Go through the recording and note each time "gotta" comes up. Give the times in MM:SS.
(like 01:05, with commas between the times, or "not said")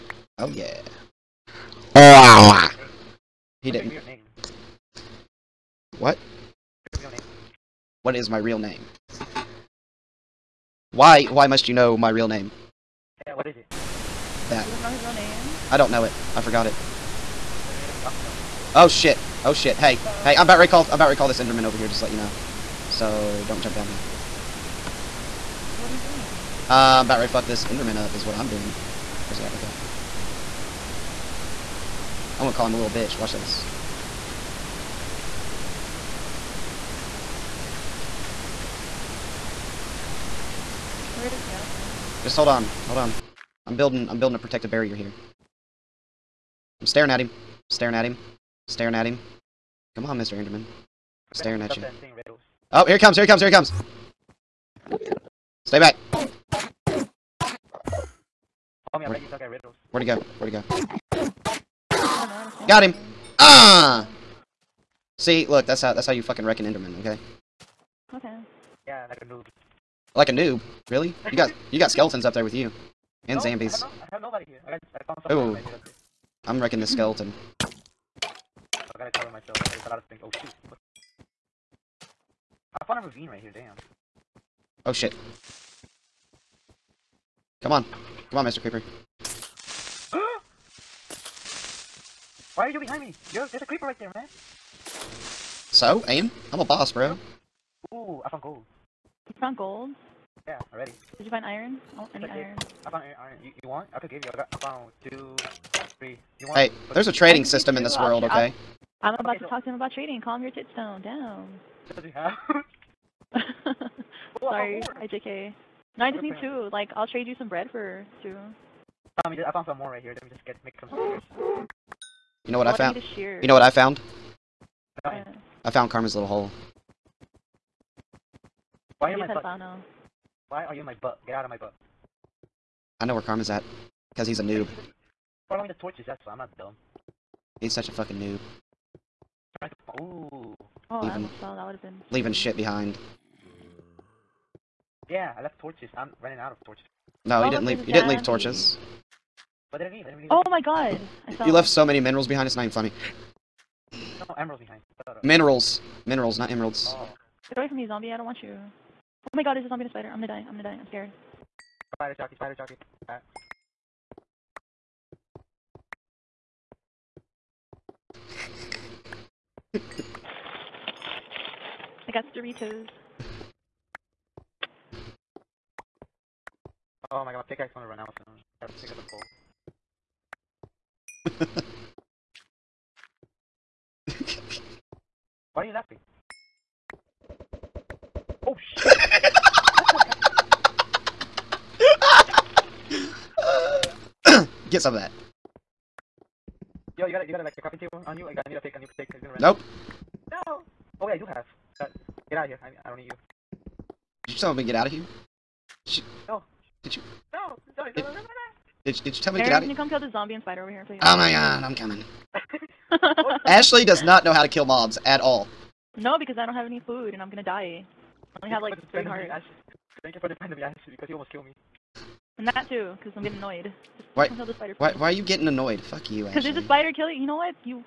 01:18.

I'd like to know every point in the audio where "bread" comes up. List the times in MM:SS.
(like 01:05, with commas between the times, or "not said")
01:57.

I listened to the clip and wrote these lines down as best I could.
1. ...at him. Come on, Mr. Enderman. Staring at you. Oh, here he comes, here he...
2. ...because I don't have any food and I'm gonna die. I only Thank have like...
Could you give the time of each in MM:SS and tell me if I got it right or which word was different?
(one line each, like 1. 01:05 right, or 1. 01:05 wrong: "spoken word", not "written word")
1. 00:48 right
2. 03:36 right.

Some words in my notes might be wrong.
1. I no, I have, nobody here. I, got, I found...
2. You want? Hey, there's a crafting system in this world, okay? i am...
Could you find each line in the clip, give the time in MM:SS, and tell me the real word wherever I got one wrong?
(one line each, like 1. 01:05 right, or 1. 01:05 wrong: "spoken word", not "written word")
1. 01:13 right
2. 01:46 wrong: "trading", not "crafting".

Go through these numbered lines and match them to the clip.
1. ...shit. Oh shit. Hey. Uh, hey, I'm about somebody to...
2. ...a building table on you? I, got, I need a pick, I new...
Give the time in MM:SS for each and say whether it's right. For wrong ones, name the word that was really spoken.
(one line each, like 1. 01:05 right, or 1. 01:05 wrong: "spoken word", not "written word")
1. 00:18 wrong: "ready", not "somebody"
2. 03:17 wrong: "crafting", not "building".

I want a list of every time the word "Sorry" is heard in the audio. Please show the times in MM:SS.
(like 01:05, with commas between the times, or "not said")
01:54, 03:27.